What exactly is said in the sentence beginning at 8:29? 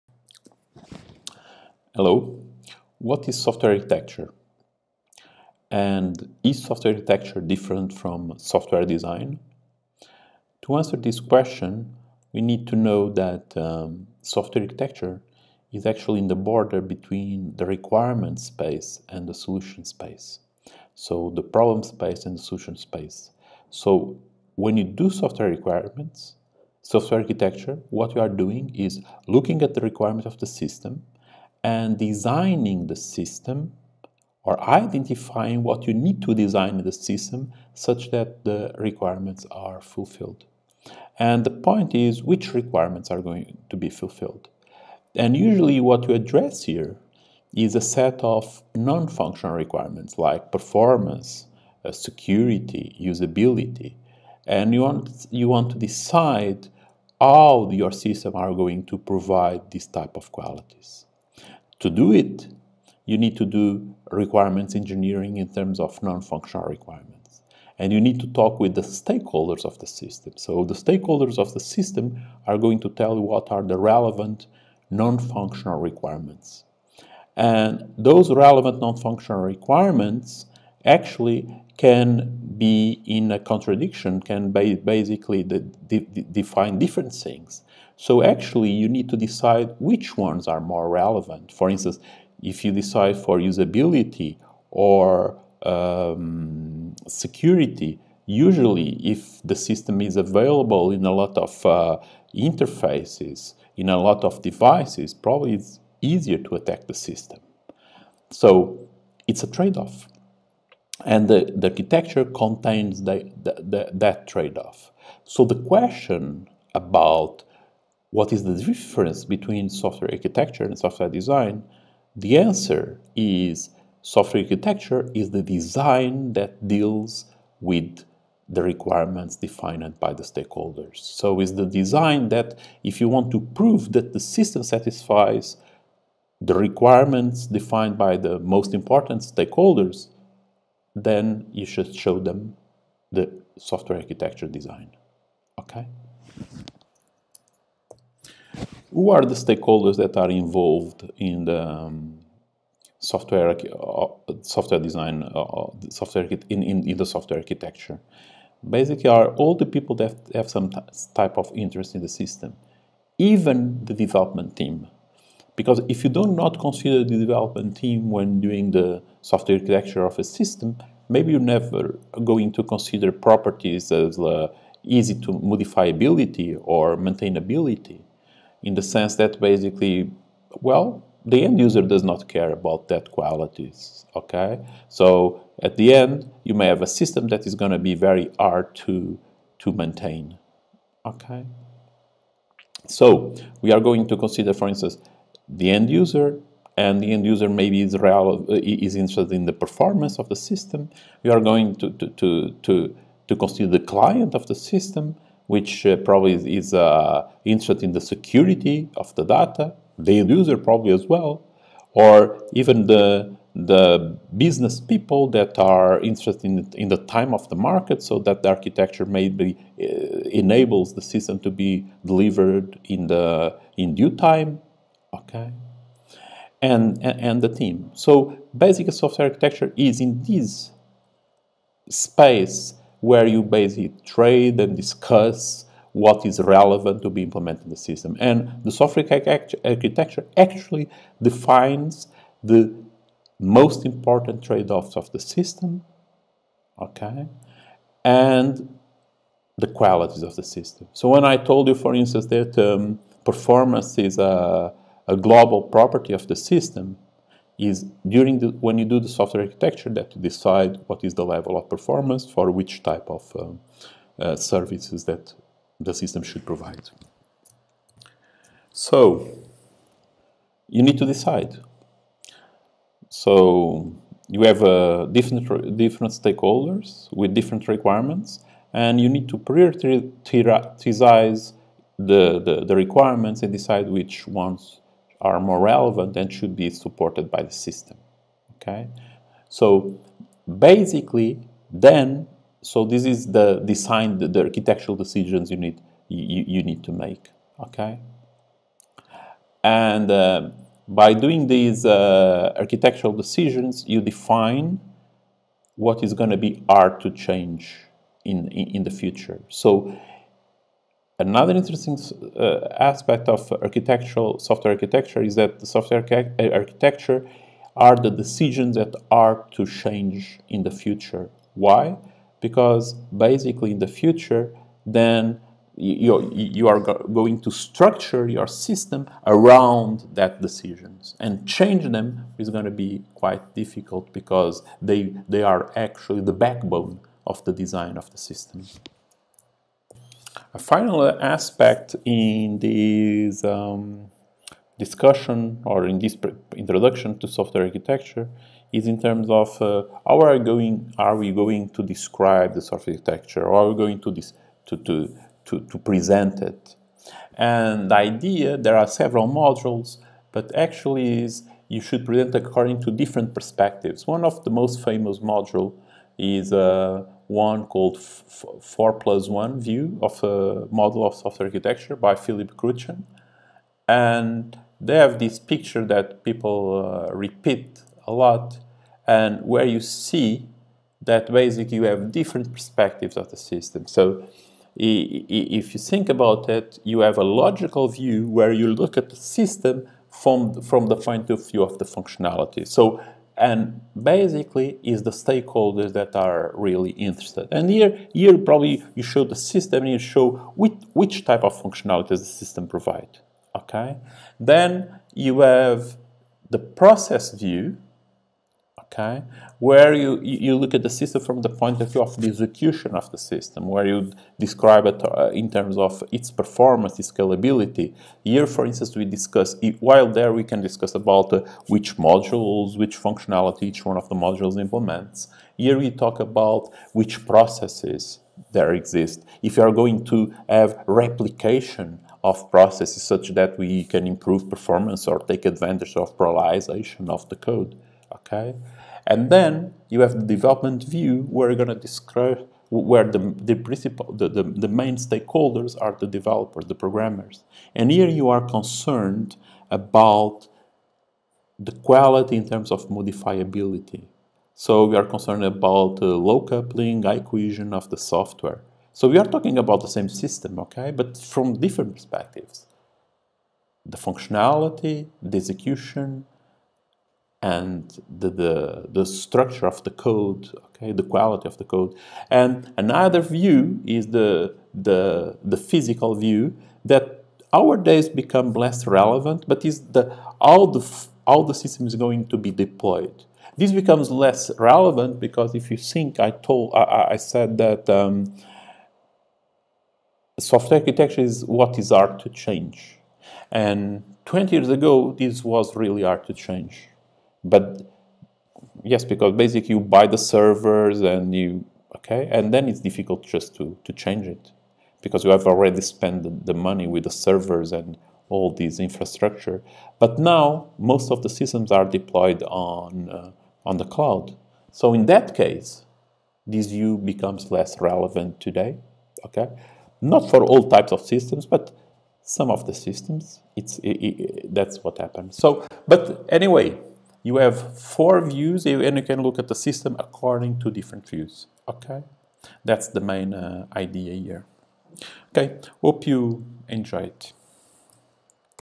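But now most of the systems are deployed on, uh, on the cloud.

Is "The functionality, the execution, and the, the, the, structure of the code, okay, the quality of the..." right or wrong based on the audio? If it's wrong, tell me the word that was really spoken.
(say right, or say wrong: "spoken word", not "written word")
right.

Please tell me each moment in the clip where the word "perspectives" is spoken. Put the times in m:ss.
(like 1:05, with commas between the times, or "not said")
6:03, 6:22, 7:41.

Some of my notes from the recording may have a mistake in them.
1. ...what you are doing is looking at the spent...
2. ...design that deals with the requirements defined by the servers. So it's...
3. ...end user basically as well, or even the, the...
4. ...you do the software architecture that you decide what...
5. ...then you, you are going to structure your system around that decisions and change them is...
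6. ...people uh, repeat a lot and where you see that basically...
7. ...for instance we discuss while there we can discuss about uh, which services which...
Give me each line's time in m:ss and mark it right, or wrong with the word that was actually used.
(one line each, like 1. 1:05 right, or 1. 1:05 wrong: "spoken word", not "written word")
1. 0:27 wrong: "requirement", not "spent"
2. 2:05 wrong: "stakeholders", not "servers"
3. 3:30 wrong: "probably", not "basically"
4. 4:18 right
5. 5:24 right
6. 6:16 right
7. 6:58 wrong: "modules", not "services".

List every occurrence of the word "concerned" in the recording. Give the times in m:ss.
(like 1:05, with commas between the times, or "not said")
7:28, 7:35.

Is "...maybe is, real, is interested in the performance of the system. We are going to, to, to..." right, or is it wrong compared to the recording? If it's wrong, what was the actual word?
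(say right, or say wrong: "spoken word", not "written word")
right.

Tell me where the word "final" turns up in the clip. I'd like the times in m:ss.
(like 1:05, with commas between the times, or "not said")
5:40.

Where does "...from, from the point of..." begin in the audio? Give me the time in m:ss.
6:30.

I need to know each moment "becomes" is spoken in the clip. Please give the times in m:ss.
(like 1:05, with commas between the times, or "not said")
7:58, 8:03, 8:36.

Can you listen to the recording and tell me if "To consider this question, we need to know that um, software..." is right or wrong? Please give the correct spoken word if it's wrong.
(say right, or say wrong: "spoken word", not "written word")
wrong: "answer", not "consider".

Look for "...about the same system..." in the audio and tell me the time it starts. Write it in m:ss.
7:39.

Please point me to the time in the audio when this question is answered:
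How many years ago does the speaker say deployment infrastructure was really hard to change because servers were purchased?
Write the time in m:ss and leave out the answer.
8:14.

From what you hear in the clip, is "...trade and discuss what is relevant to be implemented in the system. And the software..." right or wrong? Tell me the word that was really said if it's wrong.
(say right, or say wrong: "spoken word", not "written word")
right.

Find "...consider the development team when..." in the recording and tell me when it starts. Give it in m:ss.
2:46.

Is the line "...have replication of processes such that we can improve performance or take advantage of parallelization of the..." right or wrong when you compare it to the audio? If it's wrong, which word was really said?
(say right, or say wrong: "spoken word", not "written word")
right.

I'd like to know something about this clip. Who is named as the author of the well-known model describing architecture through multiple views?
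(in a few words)
Philip Kruchten.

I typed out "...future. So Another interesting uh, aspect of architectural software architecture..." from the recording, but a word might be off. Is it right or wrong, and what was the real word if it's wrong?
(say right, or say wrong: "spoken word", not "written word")
right.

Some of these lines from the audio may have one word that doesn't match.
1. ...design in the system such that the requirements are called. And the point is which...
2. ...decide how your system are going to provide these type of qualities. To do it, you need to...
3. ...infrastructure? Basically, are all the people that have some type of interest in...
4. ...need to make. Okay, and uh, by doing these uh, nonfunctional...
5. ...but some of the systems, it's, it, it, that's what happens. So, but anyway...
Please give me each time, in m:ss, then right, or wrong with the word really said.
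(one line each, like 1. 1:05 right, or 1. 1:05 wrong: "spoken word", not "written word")
1. 0:36 wrong: "fulfilled", not "called"
2. 0:55 right
3. 2:37 wrong: "architecture", not "infrastructure"
4. 4:56 wrong: "architectural", not "nonfunctional"
5. 8:41 right.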